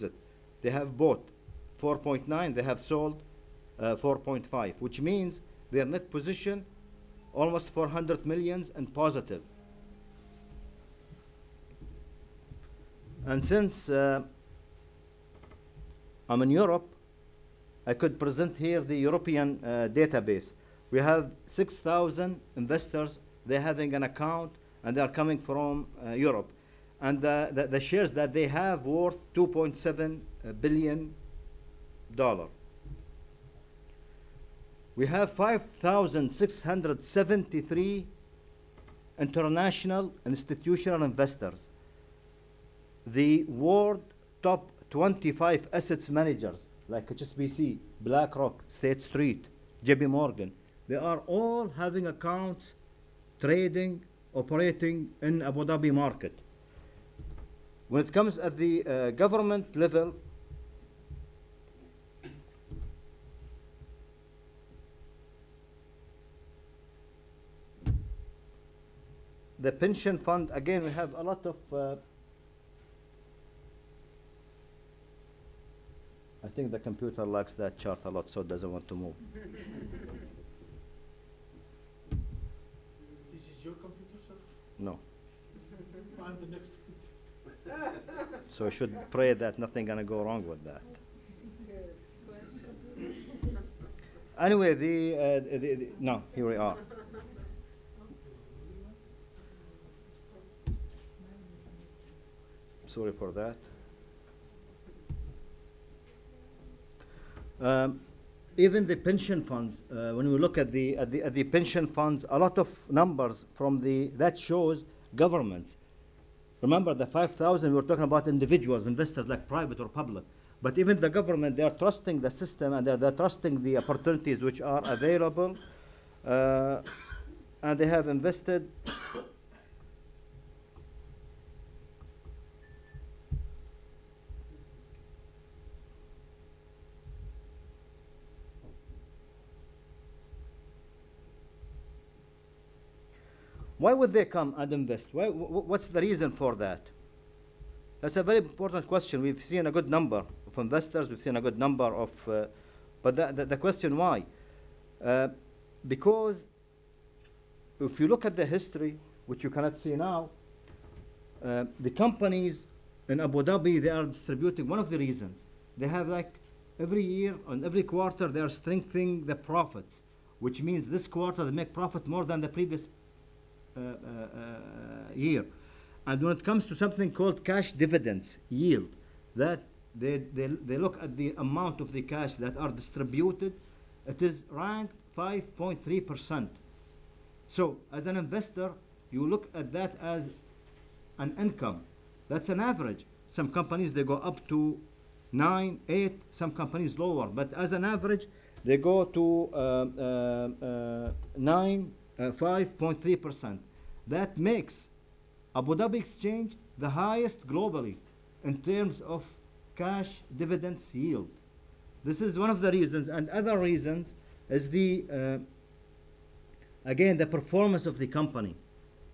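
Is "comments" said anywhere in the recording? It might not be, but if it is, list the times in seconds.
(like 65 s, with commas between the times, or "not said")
not said.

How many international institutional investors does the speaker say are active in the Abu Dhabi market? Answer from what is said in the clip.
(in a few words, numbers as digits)
5,673.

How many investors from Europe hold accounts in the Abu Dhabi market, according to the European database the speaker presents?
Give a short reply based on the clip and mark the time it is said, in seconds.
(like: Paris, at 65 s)
6,000, at 21 s.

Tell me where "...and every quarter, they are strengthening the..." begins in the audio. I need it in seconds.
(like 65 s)
167 s.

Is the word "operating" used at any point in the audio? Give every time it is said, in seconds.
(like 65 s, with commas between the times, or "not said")
54 s.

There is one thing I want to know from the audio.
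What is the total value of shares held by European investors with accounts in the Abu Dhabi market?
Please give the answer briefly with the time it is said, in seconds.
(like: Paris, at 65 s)
2.7 billion dollars, at 29 s.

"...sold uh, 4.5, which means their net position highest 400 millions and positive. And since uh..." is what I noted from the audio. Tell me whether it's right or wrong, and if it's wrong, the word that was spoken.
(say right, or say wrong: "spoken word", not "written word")
wrong: "almost", not "highest".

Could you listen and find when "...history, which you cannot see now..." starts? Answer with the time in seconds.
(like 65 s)
158 s.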